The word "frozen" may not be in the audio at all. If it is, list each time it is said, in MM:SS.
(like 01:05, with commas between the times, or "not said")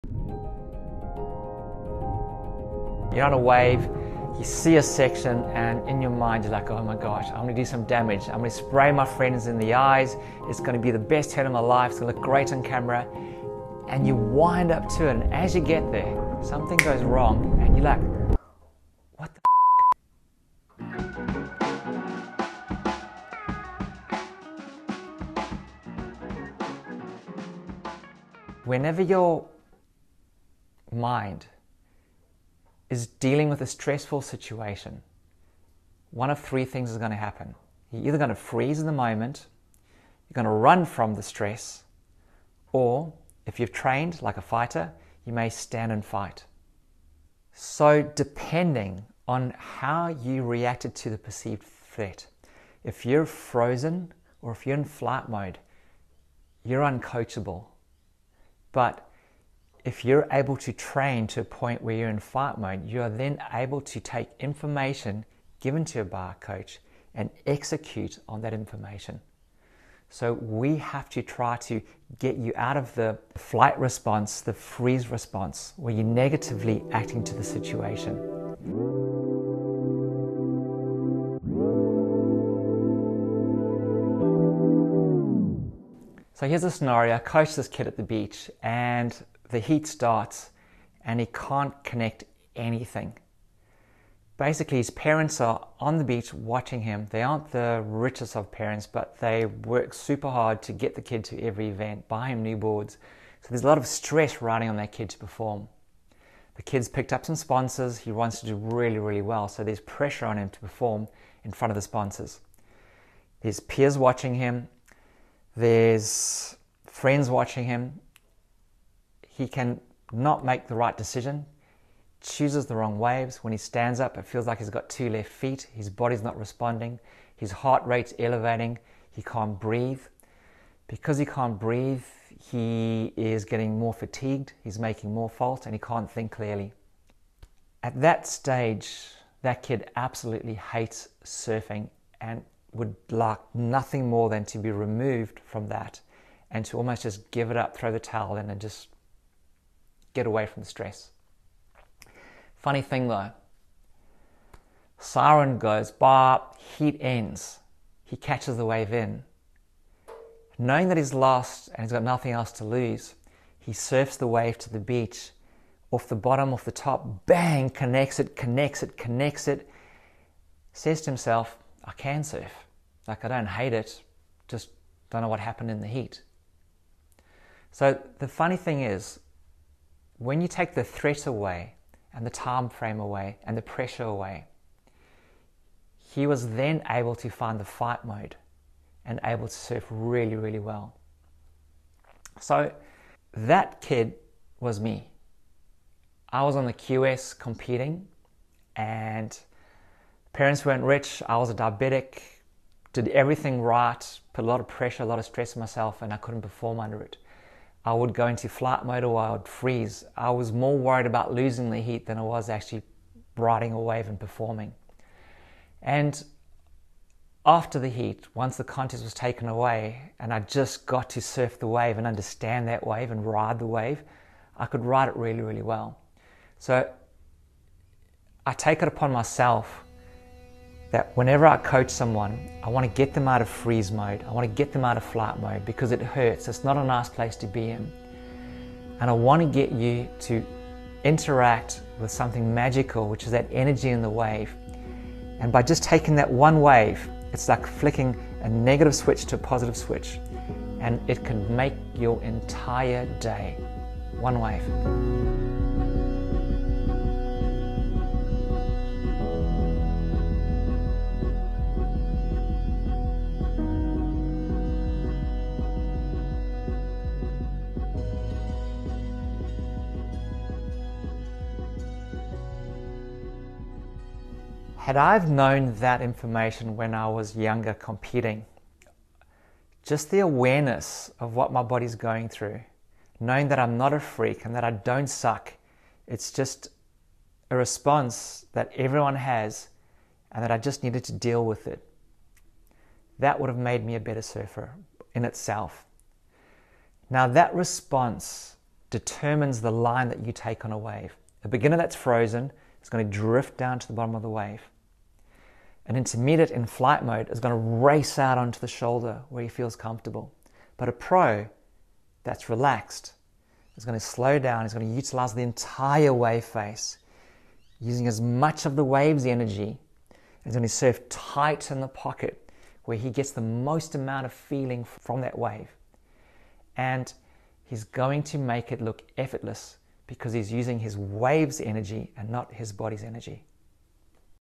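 00:53, 05:01.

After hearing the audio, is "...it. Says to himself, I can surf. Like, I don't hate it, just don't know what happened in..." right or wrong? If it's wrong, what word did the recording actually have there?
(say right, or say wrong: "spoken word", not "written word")
right.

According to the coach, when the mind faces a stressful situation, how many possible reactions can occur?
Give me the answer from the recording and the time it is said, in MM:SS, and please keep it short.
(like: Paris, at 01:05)
3, at 00:36.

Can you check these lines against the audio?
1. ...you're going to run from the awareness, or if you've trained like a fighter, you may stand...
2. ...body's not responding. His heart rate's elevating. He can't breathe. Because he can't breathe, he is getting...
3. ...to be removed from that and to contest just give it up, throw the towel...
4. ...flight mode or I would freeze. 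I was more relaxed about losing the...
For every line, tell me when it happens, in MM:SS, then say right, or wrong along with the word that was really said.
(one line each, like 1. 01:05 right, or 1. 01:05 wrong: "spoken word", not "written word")
1. 00:40 wrong: "stress", not "awareness"
2. 02:05 right
3. 02:24 wrong: "almost", not "contest"
4. 03:28 wrong: "worried", not "relaxed".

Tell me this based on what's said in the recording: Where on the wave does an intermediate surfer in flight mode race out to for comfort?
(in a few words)
the shoulder.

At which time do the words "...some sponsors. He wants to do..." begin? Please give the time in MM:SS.
01:47.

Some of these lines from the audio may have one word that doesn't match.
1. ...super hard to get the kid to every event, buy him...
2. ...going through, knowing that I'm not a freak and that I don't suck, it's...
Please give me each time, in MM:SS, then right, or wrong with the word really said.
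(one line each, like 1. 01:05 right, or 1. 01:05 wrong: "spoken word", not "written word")
1. 01:39 right
2. 04:41 right.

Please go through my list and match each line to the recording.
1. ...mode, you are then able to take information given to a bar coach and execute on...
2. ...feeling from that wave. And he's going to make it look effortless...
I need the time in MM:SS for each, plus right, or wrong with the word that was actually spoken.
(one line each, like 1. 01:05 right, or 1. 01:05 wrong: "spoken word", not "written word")
1. 01:02 right
2. 05:24 right.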